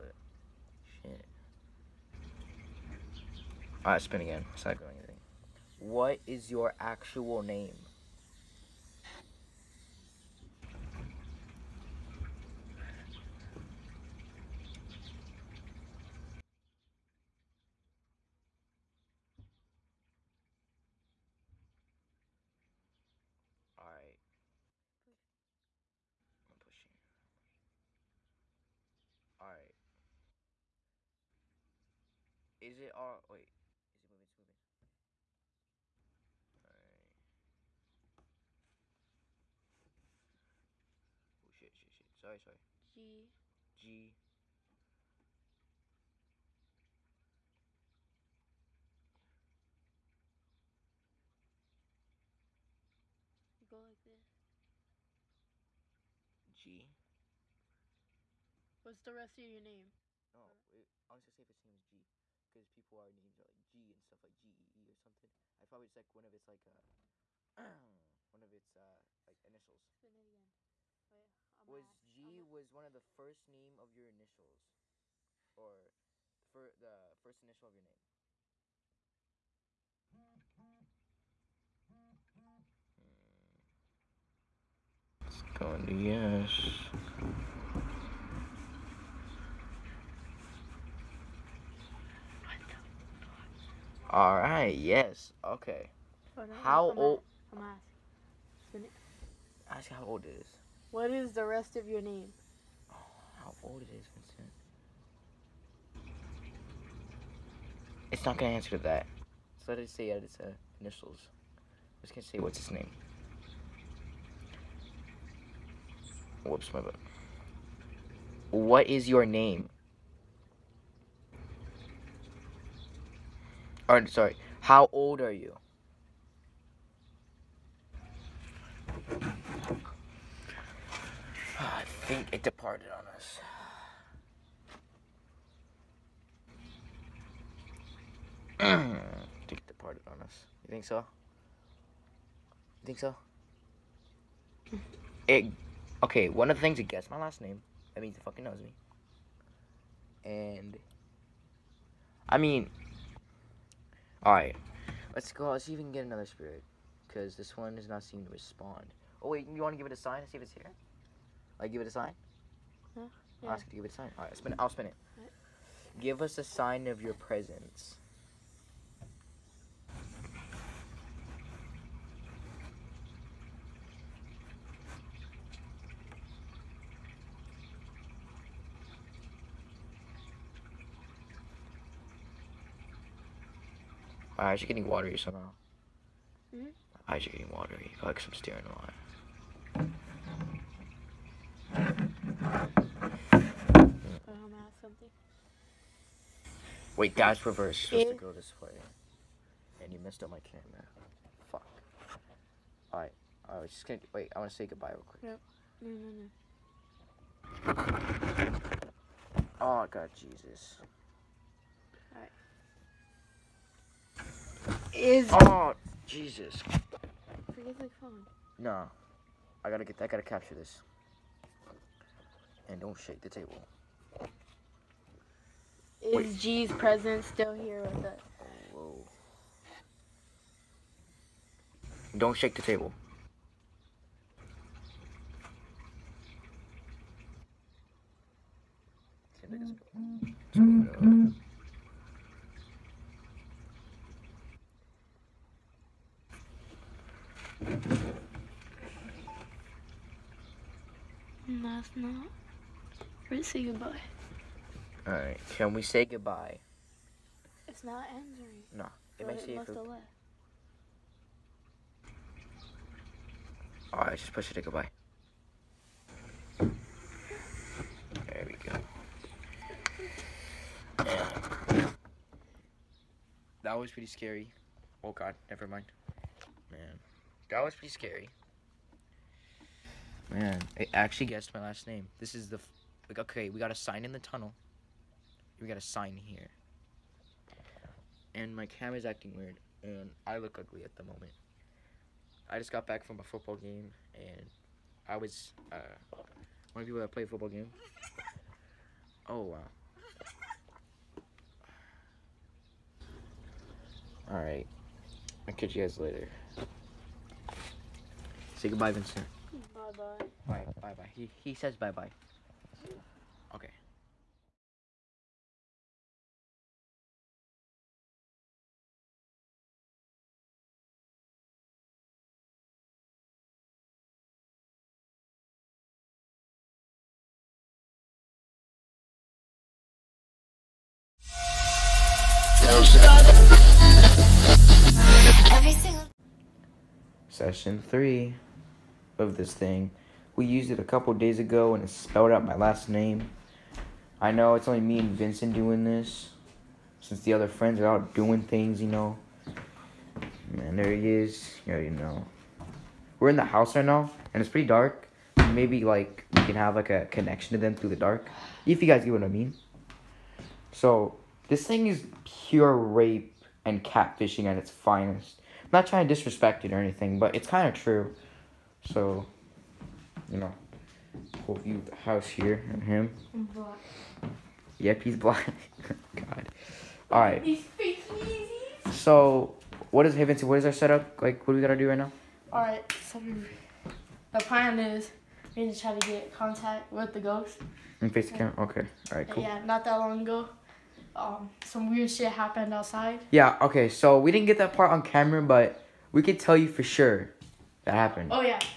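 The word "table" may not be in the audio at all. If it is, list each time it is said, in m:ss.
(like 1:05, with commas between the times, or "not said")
3:43, 3:52.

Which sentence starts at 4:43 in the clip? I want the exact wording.
Like, okay, we got a sign in the tunnel.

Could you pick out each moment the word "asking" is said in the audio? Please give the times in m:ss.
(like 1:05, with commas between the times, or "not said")
1:38.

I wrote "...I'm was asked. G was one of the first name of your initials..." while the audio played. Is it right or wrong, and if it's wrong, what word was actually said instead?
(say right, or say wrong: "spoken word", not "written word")
right.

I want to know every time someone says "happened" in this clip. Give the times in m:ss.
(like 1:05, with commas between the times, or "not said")
6:32, 6:37.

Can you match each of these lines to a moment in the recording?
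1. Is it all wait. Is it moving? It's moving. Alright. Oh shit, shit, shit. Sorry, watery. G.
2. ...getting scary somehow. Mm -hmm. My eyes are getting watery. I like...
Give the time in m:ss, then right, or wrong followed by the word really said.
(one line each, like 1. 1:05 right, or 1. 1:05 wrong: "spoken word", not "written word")
1. 0:32 wrong: "sorry", not "watery"
2. 3:04 wrong: "watery", not "scary".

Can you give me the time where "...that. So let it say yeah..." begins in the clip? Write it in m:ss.
1:48.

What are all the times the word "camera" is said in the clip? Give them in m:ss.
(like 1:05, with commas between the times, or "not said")
3:20, 4:48, 6:28, 6:35.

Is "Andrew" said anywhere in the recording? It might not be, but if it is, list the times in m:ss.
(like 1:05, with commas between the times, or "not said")
4:18.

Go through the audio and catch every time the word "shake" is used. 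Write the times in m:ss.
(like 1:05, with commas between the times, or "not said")
3:42, 3:52.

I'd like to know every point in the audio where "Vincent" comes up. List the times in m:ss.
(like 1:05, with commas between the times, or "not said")
1:44, 5:08, 5:45.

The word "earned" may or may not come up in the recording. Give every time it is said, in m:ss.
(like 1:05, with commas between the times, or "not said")
not said.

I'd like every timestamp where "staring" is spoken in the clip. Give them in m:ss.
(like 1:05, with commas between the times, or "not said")
3:08.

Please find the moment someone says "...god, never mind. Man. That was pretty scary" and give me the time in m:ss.
4:35.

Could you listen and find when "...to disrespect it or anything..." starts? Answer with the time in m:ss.
6:06.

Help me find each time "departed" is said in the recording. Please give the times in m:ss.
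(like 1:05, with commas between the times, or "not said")
2:12, 2:19.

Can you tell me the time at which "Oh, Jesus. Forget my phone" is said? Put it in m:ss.
3:35.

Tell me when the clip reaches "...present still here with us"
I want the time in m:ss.
3:46.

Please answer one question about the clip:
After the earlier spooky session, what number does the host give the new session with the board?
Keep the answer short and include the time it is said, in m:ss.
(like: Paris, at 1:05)
3, at 5:37.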